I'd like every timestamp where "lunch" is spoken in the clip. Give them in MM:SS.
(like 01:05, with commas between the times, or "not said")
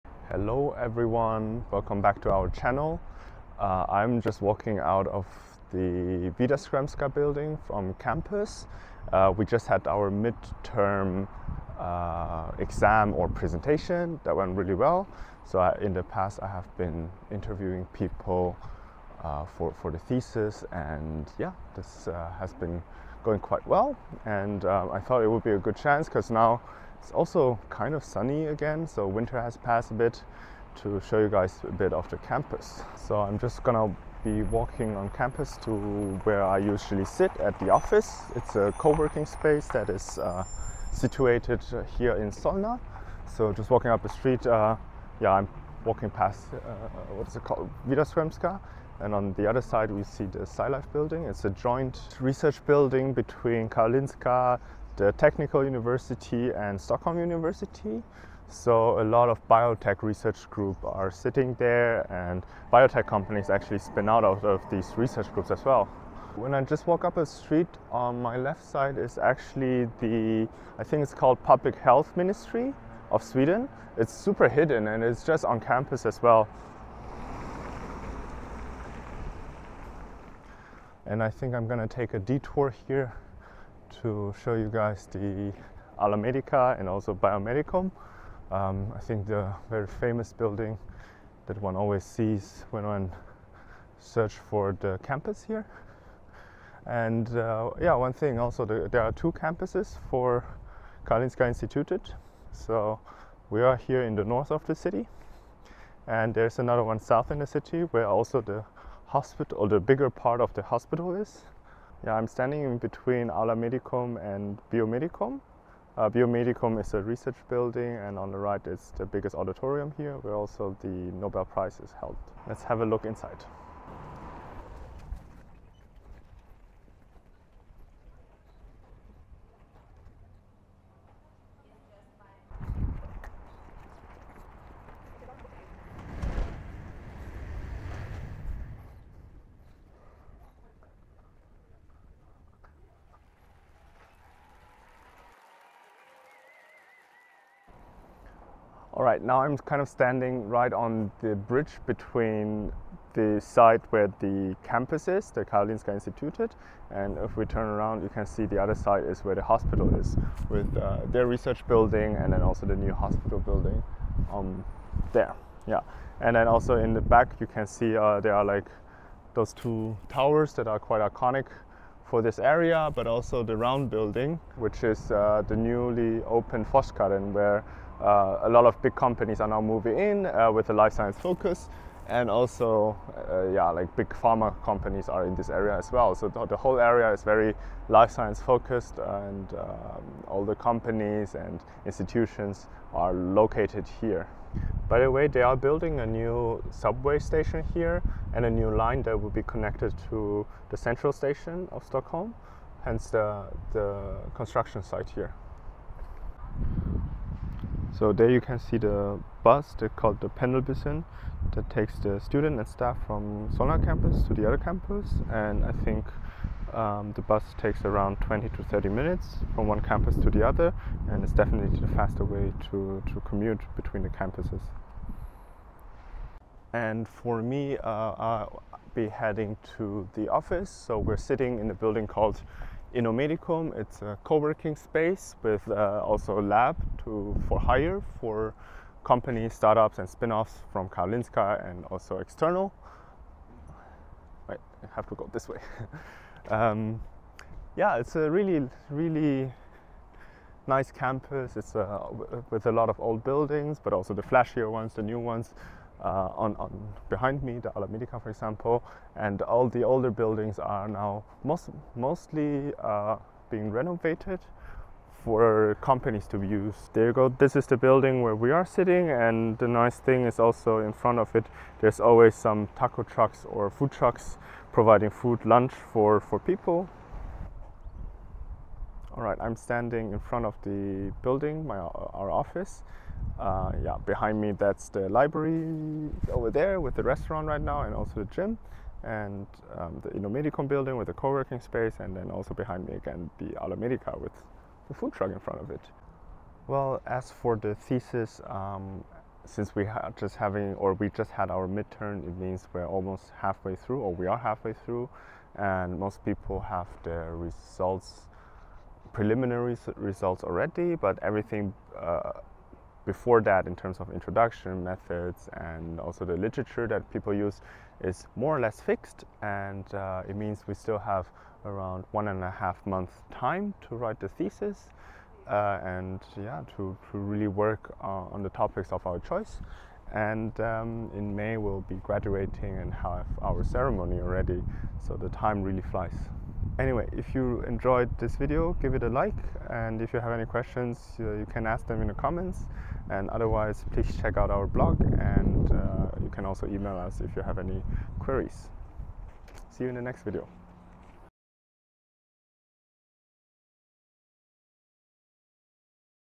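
04:35.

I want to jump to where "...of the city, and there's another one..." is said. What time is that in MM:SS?
01:44.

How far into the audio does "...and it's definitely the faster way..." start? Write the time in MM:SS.
03:41.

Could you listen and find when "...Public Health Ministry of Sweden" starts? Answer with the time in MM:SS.
01:11.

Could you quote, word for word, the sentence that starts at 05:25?
Uh, and yeah, to, to really work uh, on the topics of our choice.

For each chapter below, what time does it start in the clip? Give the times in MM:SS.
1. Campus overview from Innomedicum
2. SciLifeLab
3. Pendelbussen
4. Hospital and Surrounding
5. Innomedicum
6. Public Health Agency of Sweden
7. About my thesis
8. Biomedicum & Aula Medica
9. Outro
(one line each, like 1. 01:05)
1. 04:37
2. 00:45
3. 03:28
4. 02:30
5. 03:47
6. 01:08
7. 04:56
8. 01:22
9. 05:36.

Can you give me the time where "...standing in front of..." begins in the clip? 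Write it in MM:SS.
04:39.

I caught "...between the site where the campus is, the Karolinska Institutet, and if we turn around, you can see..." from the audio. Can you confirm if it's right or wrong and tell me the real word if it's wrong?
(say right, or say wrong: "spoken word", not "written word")
right.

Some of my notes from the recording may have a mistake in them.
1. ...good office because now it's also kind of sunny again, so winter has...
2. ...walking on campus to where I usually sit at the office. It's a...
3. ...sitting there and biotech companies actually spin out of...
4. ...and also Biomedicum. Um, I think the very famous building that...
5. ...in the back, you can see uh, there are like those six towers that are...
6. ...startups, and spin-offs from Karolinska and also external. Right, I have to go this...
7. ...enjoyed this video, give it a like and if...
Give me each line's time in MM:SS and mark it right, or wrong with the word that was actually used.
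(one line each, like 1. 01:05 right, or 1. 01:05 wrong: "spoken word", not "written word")
1. 00:25 wrong: "chance", not "office"
2. 00:34 right
3. 01:01 right
4. 01:26 right
5. 02:46 wrong: "two", not "six"
6. 03:59 right
7. 05:37 right.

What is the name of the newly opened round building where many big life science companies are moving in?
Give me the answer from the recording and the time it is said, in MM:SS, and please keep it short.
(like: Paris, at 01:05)
Forskaren, at 02:56.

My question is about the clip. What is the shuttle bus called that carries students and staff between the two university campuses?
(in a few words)
Pendelbussen.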